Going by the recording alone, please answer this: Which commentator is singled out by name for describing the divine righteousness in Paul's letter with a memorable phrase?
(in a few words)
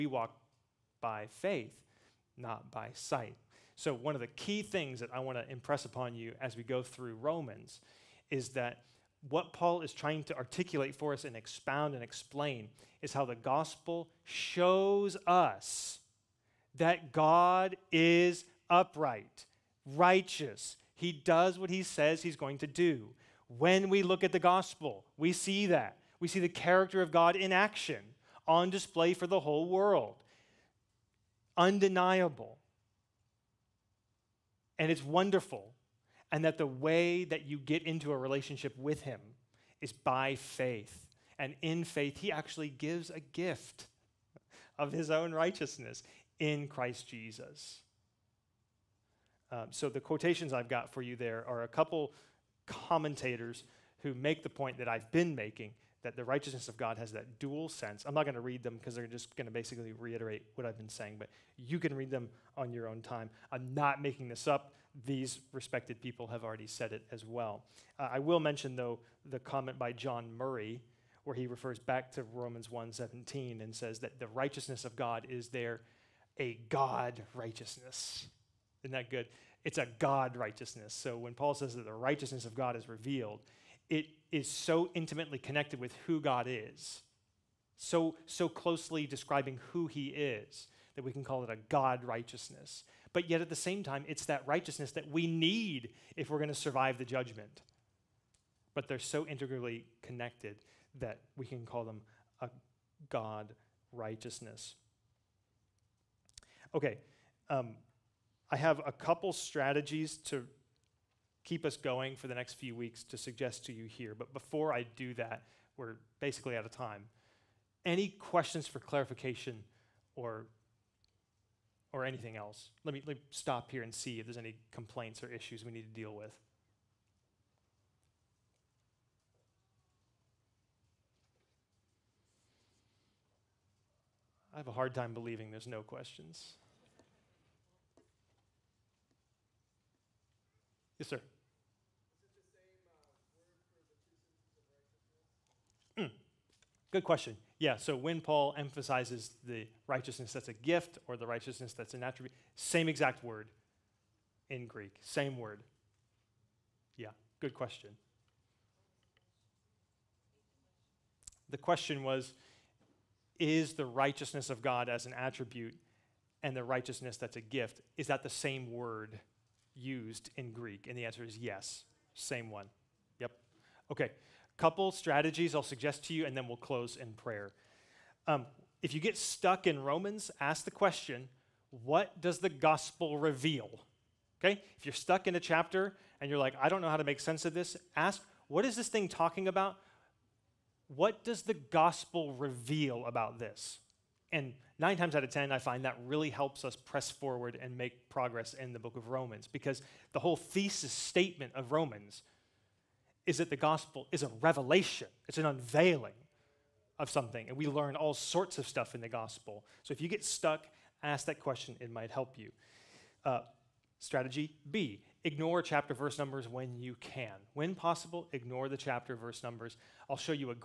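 John Murray.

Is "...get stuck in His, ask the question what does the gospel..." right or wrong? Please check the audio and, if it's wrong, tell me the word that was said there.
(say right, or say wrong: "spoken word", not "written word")
wrong: "Romans", not "His".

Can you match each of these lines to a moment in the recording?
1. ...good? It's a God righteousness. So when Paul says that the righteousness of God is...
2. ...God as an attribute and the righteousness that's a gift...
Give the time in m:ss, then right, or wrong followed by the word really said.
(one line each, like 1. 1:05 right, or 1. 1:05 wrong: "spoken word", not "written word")
1. 1:19 right
2. 2:44 right.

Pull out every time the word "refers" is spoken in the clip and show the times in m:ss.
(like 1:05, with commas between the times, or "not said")
1:11.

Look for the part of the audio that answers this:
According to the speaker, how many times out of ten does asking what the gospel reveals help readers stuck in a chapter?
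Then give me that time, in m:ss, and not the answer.
3:14.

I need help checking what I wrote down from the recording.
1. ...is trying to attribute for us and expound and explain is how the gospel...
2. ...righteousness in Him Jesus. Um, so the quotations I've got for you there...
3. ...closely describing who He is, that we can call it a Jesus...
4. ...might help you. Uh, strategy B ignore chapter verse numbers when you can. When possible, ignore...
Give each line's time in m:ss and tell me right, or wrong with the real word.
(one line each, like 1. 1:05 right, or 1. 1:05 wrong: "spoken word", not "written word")
1. 0:09 wrong: "articulate", not "attribute"
2. 0:45 wrong: "Christ", not "Him"
3. 1:28 wrong: "God", not "Jesus"
4. 3:31 right.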